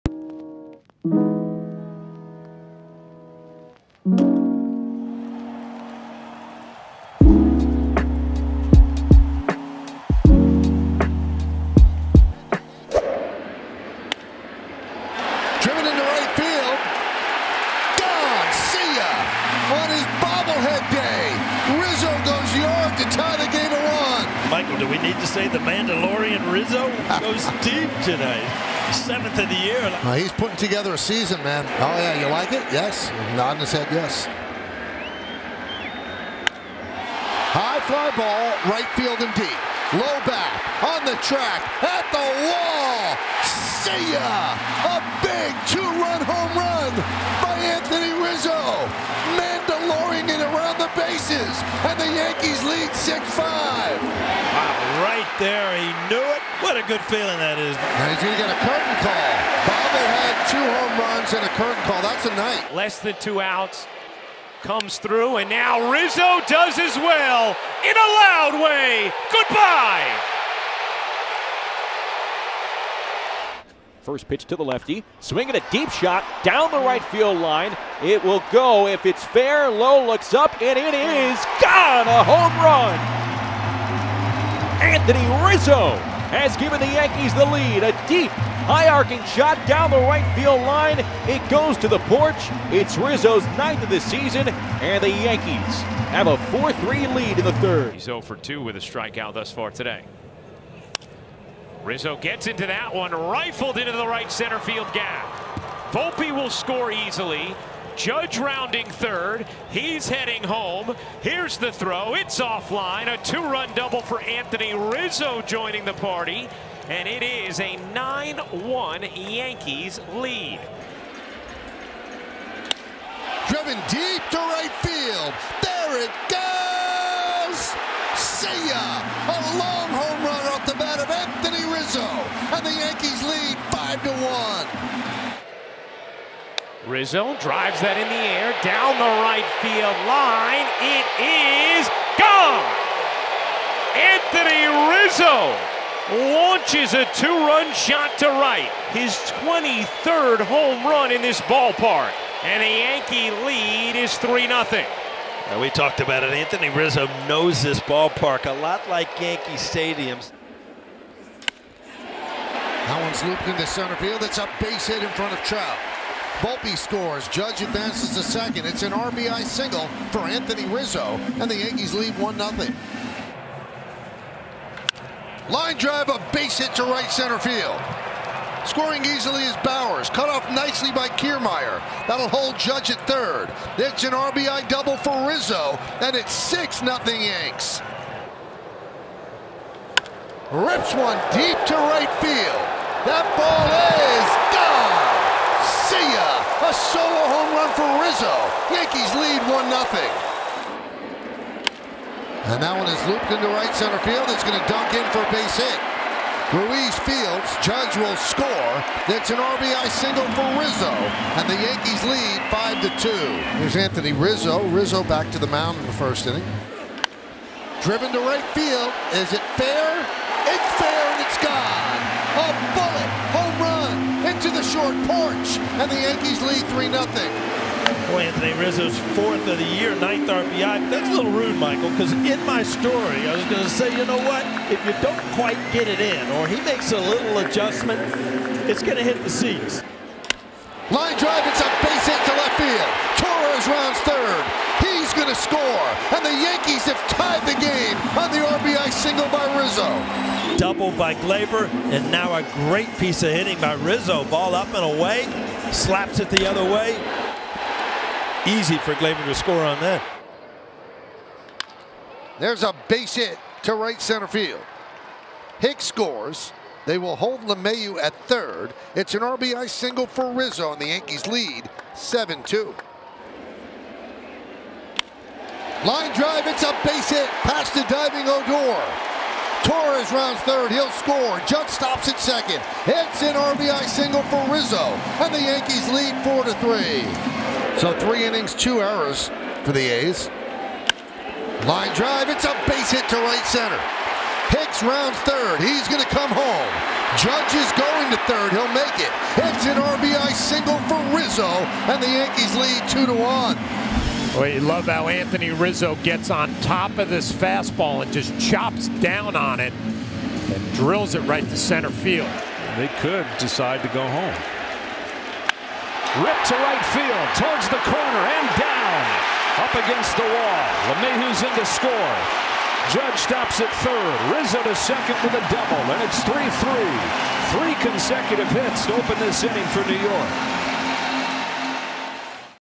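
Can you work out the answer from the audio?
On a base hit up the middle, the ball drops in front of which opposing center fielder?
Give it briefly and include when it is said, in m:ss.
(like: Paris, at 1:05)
Trout, at 2:45.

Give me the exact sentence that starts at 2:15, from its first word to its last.
to Rizzo drives that in the air down the right field line.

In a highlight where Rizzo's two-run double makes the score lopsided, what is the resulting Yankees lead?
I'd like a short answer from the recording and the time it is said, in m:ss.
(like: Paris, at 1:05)
9-1, at 1:57.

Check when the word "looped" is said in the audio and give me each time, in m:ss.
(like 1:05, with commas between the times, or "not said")
2:43, 3:23.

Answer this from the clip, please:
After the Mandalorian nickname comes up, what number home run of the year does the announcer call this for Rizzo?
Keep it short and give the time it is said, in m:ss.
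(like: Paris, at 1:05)
7th, at 0:28.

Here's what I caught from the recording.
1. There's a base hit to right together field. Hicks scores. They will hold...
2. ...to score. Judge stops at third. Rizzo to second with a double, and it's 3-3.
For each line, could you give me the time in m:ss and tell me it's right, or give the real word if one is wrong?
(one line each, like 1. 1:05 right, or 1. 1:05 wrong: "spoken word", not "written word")
1. 4:22 wrong: "center", not "together"
2. 5:21 right.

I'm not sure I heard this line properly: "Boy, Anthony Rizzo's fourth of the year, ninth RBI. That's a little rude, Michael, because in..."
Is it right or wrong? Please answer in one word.
right.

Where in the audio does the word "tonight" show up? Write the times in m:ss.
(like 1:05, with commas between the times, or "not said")
0:28.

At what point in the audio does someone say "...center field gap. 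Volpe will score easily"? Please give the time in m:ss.
1:44.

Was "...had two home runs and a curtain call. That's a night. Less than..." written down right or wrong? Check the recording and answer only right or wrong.
right.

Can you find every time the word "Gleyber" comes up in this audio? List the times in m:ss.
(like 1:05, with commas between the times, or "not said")
4:11, 4:18.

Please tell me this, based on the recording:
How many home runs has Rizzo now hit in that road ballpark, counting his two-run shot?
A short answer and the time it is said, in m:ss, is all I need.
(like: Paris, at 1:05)
23rd, at 2:29.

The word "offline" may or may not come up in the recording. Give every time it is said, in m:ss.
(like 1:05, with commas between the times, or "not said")
1:52.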